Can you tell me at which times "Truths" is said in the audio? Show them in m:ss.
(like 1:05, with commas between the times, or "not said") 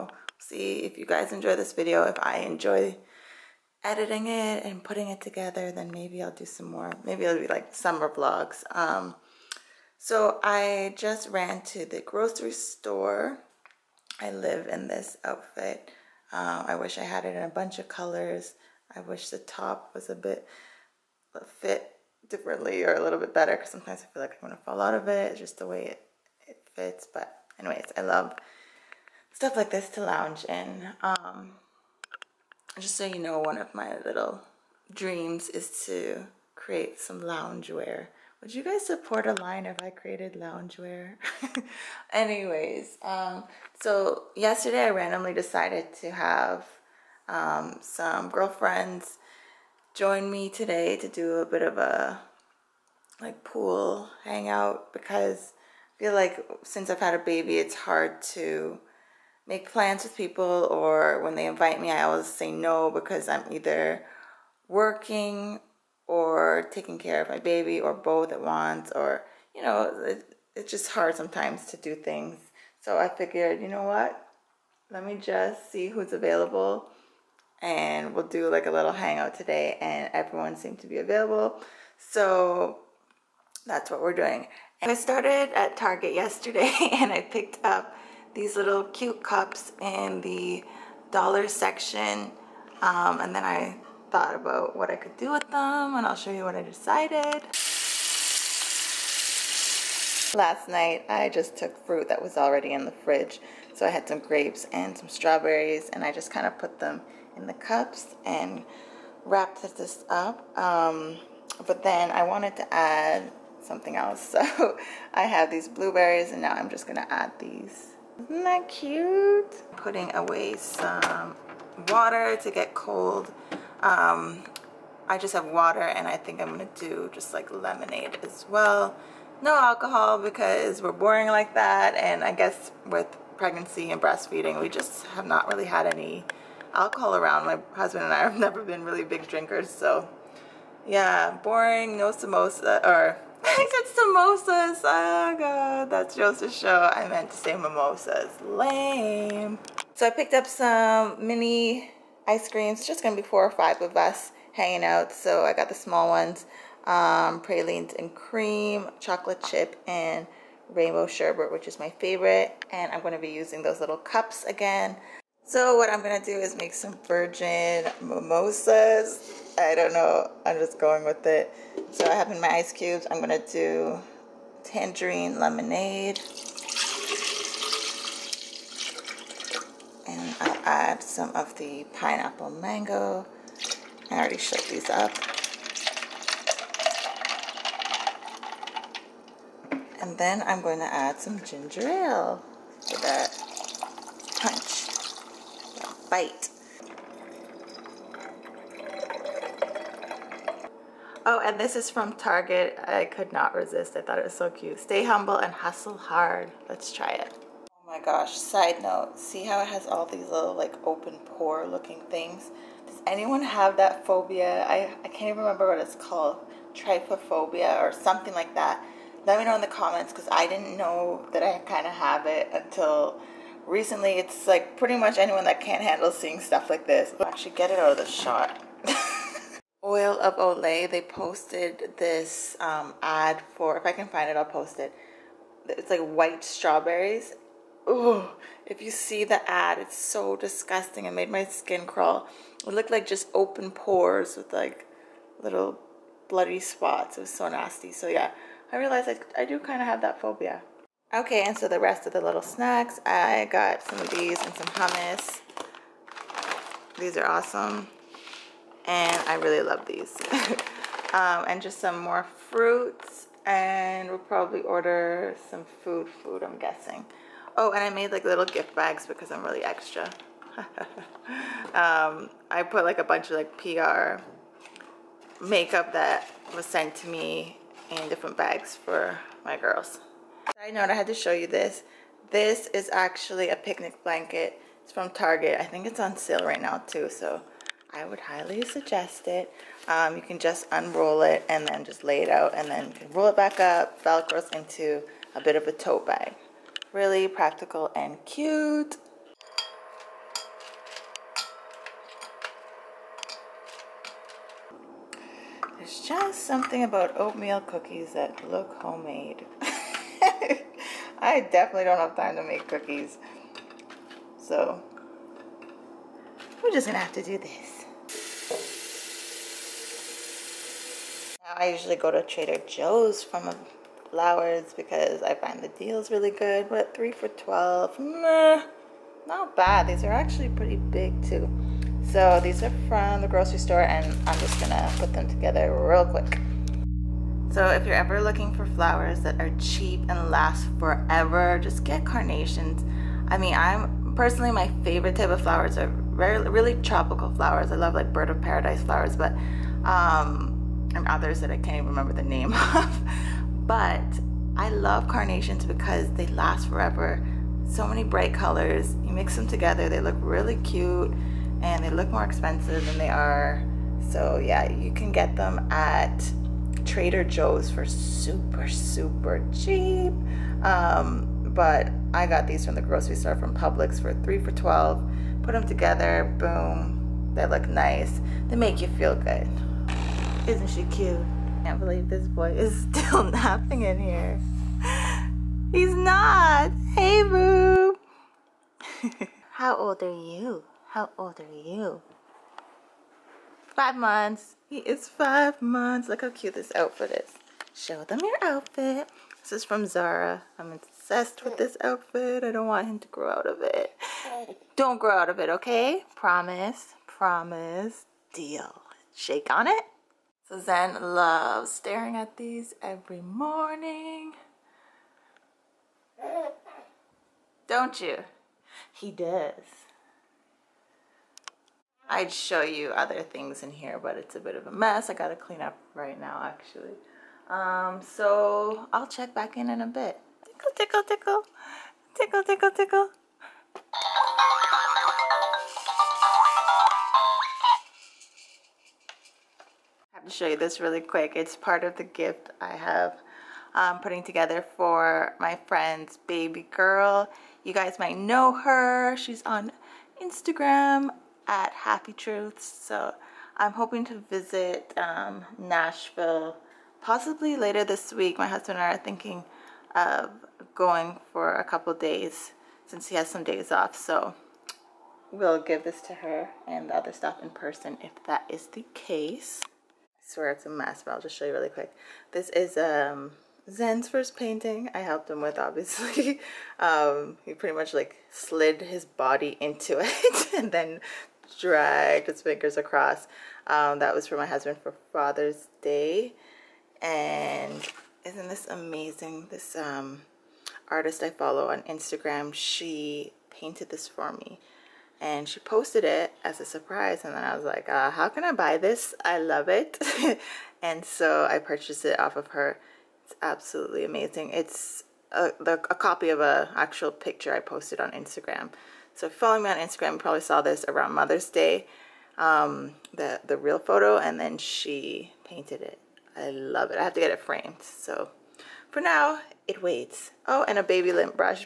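7:32.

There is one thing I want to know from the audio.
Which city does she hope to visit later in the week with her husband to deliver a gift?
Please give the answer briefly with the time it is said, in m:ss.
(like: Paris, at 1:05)
Nashville, at 7:35.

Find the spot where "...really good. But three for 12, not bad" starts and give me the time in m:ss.
5:26.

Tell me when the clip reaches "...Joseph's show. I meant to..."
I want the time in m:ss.
2:26.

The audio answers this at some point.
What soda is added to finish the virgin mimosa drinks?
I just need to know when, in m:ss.
3:11.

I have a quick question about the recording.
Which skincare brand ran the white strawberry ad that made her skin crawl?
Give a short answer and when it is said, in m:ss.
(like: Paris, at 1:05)
Oil of Olay, at 3:49.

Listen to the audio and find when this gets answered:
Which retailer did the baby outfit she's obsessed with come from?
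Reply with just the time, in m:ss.
6:39.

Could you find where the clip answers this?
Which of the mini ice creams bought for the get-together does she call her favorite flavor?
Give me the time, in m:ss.
2:40.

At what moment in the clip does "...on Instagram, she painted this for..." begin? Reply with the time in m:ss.
8:11.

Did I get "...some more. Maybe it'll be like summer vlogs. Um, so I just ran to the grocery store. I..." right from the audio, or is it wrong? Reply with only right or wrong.
right.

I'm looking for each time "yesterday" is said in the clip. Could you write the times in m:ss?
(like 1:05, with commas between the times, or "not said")
0:44, 1:26.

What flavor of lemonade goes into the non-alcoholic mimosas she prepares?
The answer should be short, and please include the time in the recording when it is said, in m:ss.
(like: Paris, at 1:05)
Tangerine lemonade, at 2:54.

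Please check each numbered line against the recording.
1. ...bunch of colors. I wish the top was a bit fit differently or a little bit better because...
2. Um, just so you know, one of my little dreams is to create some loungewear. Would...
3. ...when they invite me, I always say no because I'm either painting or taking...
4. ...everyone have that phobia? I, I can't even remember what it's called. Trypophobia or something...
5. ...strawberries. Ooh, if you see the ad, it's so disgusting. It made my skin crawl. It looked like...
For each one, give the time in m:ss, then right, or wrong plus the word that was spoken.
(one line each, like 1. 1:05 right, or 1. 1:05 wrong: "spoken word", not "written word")
1. 0:17 right
2. 0:31 right
3. 1:01 wrong: "working", not "painting"
4. 3:33 wrong: "anyone", not "everyone"
5. 3:56 right.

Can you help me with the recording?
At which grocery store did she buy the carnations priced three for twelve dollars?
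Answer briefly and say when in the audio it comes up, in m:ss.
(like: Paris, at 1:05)
Publix, at 6:13.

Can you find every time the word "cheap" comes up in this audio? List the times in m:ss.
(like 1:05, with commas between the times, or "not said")
5:39, 6:09.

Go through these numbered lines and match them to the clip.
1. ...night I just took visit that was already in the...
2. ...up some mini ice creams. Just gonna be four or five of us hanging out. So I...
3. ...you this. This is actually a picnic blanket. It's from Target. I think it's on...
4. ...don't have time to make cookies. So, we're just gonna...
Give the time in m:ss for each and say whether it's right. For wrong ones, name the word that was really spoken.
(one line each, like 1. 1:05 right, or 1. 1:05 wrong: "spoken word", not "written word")
1. 1:40 wrong: "fruit", not "visit"
2. 2:30 right
3. 4:41 right
4. 5:11 right.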